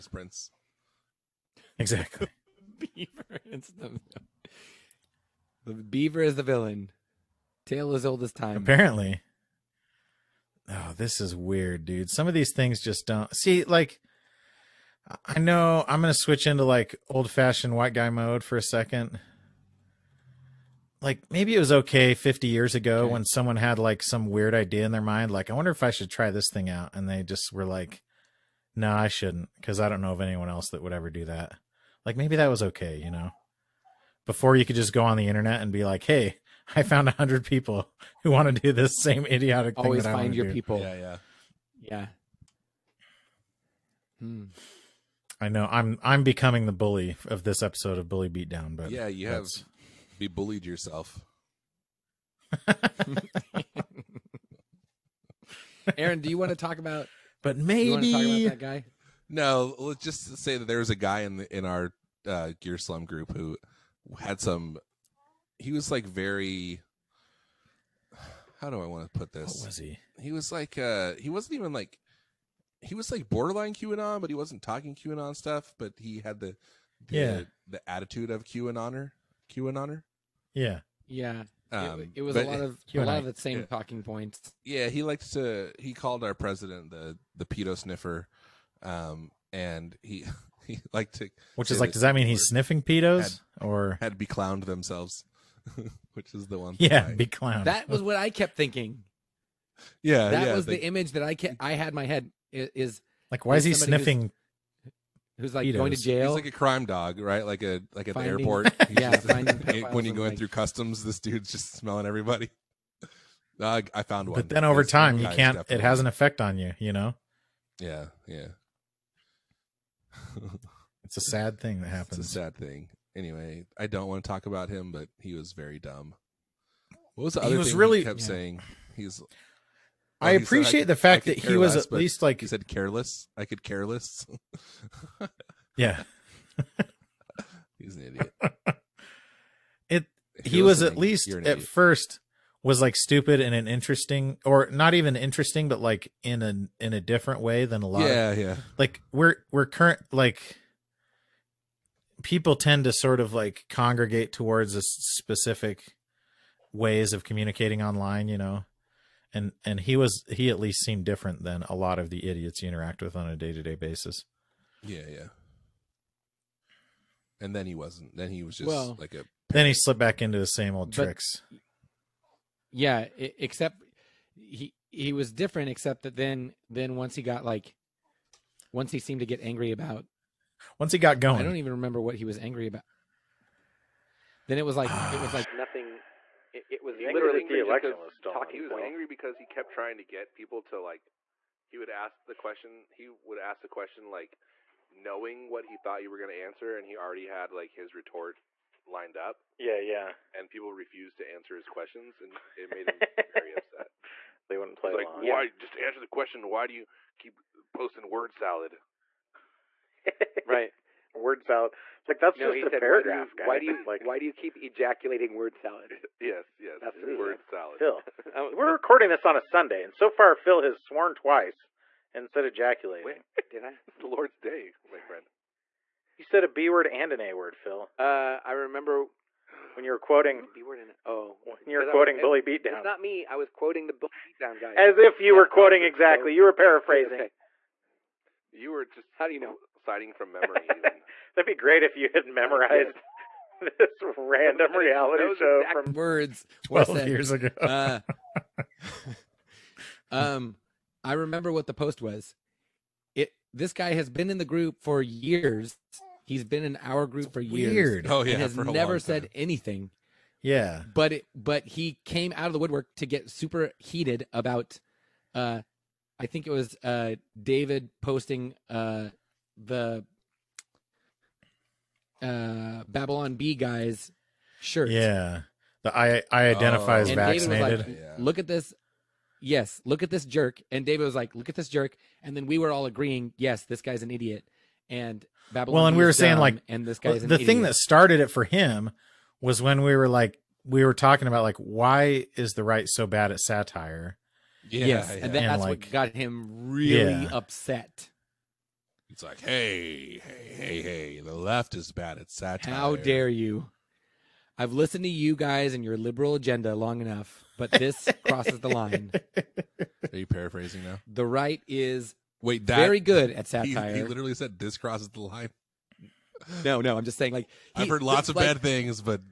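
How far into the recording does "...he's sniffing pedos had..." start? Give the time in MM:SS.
01:32.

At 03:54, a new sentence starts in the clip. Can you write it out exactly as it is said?
As if you yeah, were quoting exactly.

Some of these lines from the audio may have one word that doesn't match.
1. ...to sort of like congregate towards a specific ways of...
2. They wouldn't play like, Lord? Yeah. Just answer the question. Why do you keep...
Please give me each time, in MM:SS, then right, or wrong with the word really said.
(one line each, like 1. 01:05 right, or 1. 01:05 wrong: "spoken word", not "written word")
1. 02:32 right
2. 03:24 wrong: "Why", not "Lord".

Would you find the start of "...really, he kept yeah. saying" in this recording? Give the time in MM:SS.
02:07.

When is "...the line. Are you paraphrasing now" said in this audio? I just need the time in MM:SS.
05:08.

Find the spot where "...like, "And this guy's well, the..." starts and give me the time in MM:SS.
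04:46.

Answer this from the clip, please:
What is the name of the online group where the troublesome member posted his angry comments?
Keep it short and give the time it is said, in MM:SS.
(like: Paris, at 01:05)
Gear Slum, at 01:02.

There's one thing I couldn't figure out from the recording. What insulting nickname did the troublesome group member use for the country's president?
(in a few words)
the pedo sniffer.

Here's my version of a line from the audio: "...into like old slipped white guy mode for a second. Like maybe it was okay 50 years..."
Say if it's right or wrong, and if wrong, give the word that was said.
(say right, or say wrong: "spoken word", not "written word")
wrong: "fashioned", not "slipped".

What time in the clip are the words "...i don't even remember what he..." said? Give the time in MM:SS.
03:01.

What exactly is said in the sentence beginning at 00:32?
Like maybe that was okay, you know.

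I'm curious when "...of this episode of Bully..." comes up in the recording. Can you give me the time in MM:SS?
00:47.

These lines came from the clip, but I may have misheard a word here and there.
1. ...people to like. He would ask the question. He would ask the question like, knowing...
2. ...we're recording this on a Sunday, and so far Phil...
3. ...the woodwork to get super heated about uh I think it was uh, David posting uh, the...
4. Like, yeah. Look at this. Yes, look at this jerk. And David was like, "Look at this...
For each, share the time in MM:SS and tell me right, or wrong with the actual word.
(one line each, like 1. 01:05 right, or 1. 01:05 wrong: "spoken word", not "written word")
1. 03:10 right
2. 03:38 right
3. 04:22 right
4. 04:37 right.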